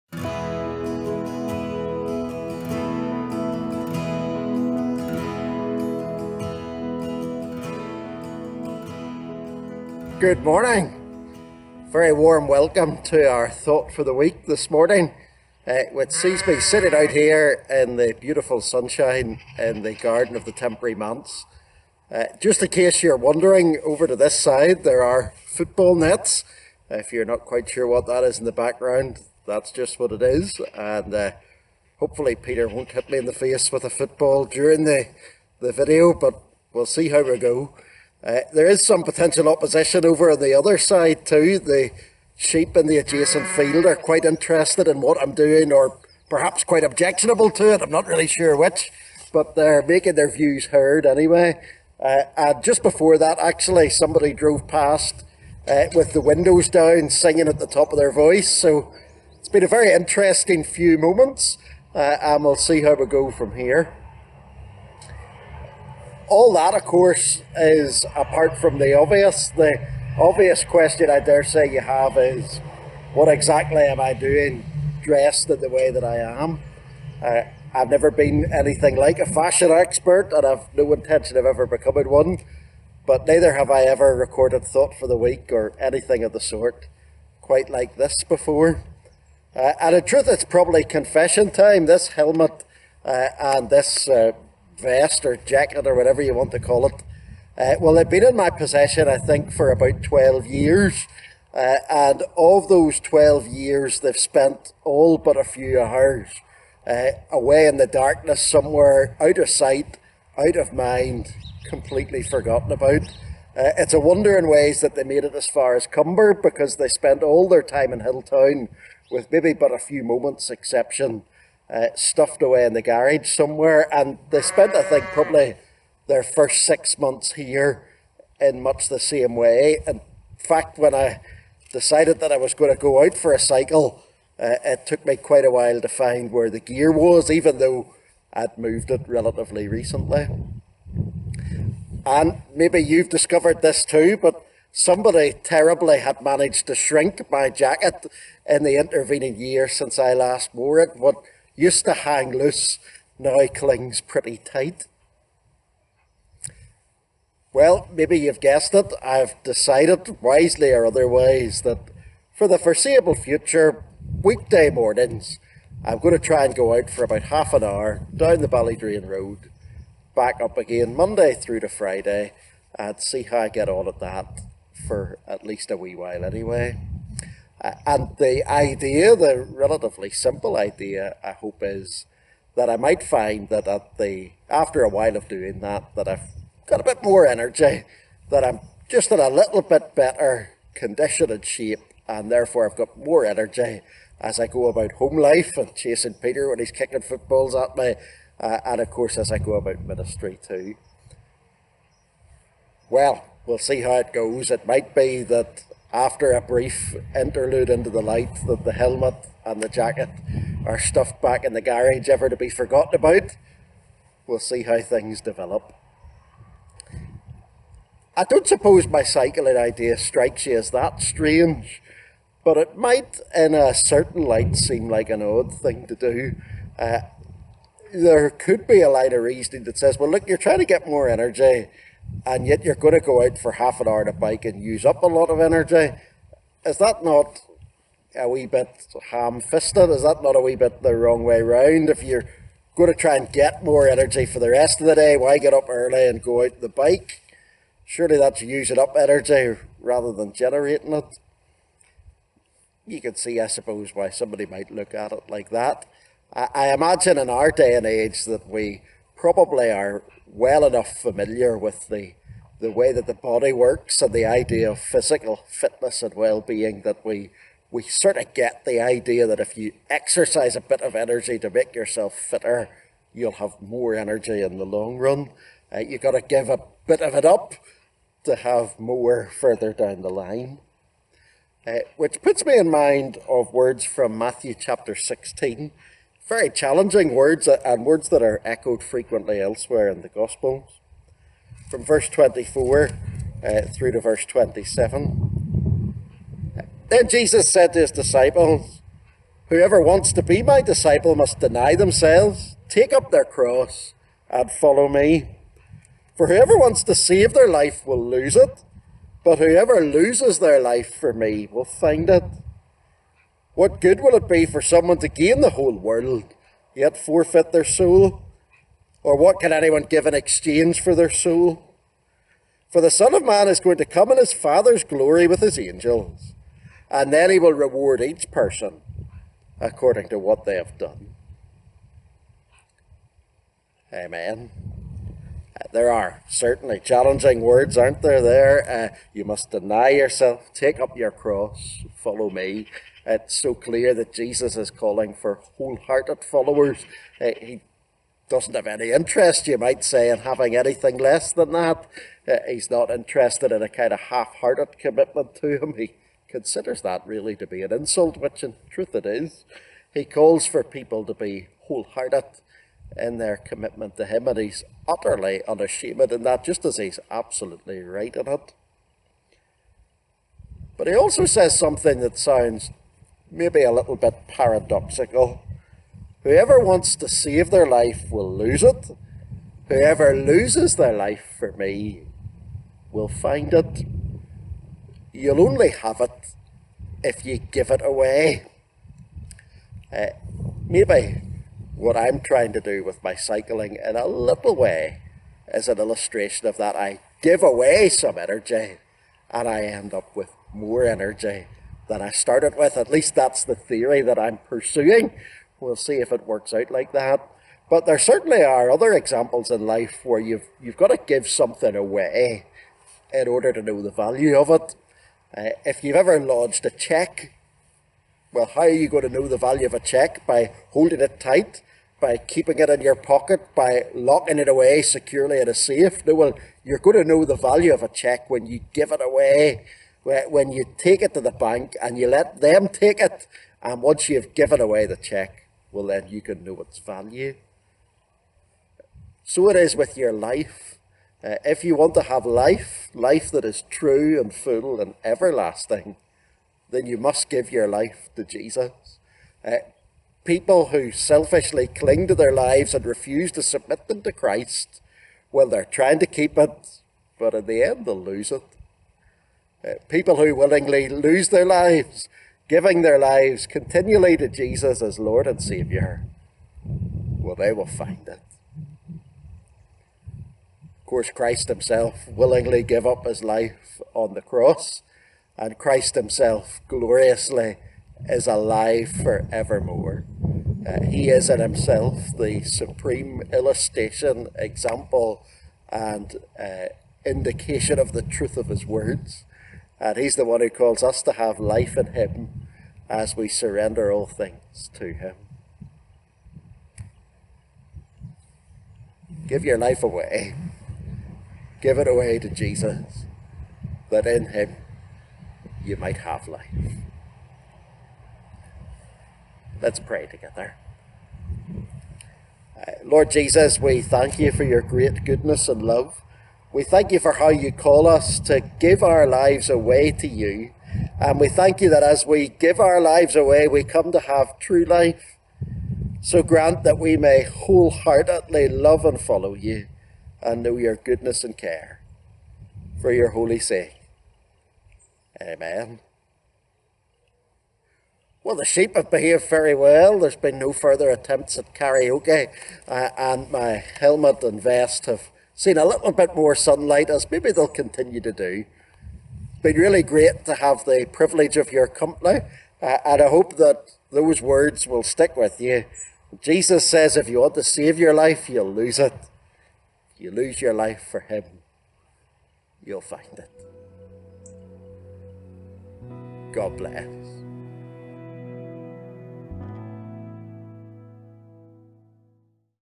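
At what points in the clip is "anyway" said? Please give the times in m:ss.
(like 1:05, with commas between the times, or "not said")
0:51, 2:56.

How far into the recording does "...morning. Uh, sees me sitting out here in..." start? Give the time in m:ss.
0:14.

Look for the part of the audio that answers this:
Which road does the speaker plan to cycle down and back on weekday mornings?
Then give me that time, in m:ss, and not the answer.
2:48.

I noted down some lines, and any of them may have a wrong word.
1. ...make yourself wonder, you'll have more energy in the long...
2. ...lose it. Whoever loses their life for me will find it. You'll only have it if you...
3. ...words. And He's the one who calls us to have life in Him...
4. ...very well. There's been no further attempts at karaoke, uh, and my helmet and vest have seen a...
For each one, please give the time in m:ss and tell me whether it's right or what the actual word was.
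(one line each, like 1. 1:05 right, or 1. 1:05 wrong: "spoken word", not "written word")
1. 4:31 wrong: "fitter", not "wonder"
2. 6:18 right
3. 8:08 right
4. 8:59 right.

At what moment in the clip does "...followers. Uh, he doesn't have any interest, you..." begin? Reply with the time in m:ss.
5:46.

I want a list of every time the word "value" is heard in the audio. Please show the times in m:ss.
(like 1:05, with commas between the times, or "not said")
6:53, 6:59, 7:07, 7:16.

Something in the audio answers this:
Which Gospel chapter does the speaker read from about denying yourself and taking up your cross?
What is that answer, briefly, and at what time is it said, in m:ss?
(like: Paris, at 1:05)
Matthew 16, at 4:44.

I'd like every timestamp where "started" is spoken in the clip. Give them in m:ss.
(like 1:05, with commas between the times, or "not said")
6:42.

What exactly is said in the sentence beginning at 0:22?
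Uh, just in case you're wondering, over to this side there are football nets.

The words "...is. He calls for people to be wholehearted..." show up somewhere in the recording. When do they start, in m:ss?
5:59.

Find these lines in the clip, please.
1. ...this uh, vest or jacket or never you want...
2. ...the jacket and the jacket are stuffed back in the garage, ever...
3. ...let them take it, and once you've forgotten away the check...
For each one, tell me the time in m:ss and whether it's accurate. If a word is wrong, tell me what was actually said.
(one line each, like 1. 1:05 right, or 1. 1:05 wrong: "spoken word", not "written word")
1. 1:33 wrong: "whatever", not "never"
2. 3:28 wrong: "helmet", not "jacket"
3. 7:12 wrong: "given", not "forgotten".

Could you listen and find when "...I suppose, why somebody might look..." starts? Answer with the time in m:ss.
4:13.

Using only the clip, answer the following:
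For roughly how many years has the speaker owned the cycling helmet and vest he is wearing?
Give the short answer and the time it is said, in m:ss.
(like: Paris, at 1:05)
12, at 1:39.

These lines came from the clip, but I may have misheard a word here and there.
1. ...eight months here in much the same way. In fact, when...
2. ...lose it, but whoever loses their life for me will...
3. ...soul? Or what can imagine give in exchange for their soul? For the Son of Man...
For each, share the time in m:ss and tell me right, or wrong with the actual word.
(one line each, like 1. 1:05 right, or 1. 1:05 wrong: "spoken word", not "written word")
1. 2:06 wrong: "six", not "eight"
2. 5:08 right
3. 5:17 wrong: "anyone", not "imagine".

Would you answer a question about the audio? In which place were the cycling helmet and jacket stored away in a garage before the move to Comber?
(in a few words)
Hilltown.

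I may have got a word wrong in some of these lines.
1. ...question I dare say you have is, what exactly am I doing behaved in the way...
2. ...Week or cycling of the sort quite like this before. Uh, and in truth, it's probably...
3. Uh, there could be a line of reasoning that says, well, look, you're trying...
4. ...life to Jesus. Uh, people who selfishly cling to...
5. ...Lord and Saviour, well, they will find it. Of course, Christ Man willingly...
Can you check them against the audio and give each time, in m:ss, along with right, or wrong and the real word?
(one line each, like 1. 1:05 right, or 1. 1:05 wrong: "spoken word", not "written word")
1. 1:10 wrong: "dressed", not "behaved"
2. 1:25 wrong: "anything", not "cycling"
3. 3:46 right
4. 7:27 right
5. 7:44 wrong: "Himself", not "Man".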